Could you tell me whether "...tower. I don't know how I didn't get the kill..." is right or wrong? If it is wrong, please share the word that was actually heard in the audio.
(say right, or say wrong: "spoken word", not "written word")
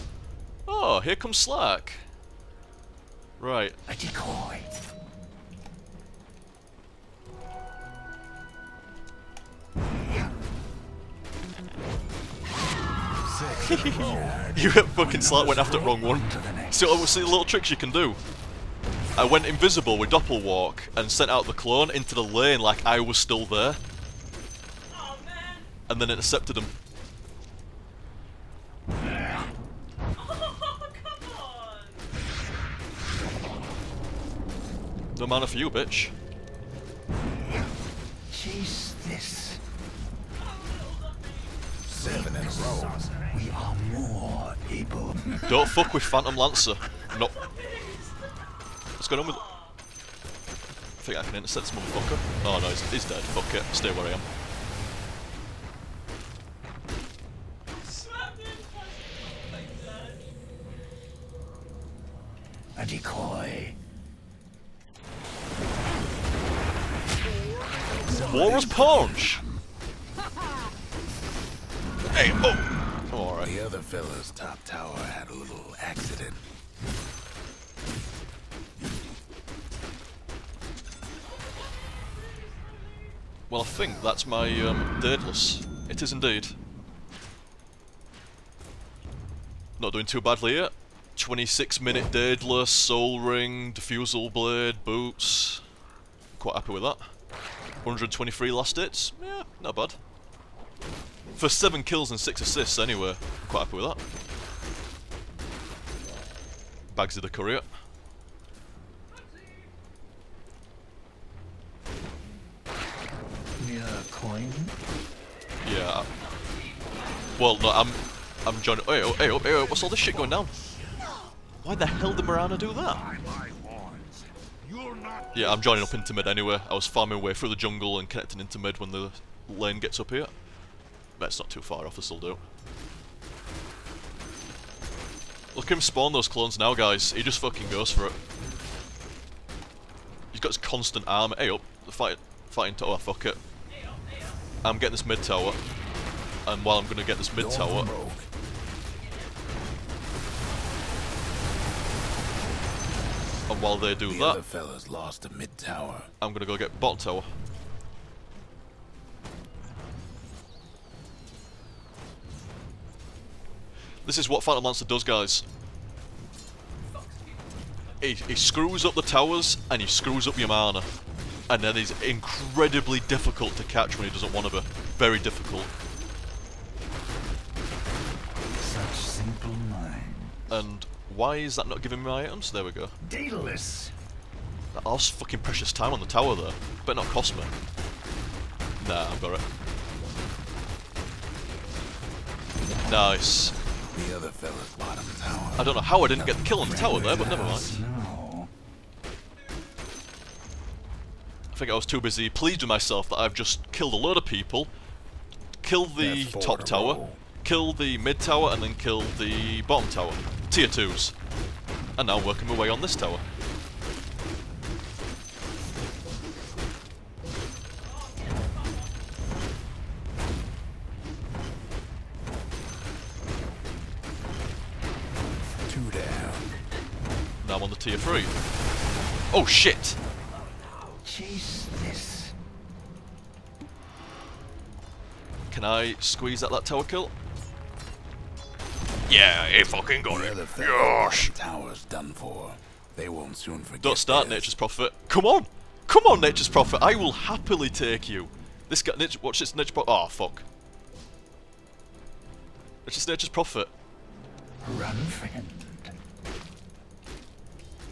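right.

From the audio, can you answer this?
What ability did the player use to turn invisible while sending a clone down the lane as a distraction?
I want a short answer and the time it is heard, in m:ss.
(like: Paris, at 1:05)
Doppelwalk, at 0:20.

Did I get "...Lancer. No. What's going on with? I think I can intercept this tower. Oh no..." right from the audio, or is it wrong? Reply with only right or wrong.
wrong.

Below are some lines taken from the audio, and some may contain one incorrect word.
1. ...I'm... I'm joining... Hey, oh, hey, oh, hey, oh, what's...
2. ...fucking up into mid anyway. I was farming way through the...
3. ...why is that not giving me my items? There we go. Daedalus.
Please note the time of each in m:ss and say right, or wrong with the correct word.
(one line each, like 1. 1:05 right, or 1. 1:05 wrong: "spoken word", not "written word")
1. 1:57 right
2. 2:05 wrong: "joining", not "fucking"
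3. 3:01 right.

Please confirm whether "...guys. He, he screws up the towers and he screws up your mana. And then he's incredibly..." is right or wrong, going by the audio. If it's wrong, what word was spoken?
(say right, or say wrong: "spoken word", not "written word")
right.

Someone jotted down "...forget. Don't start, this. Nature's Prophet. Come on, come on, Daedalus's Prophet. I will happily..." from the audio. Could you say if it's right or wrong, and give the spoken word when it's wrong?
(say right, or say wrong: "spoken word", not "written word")
wrong: "Nature", not "Daedalus".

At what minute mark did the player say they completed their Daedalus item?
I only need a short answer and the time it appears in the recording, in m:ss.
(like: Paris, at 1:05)
26, at 1:31.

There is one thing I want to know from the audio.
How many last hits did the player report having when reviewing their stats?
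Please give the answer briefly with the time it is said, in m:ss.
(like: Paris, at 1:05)
123, at 1:37.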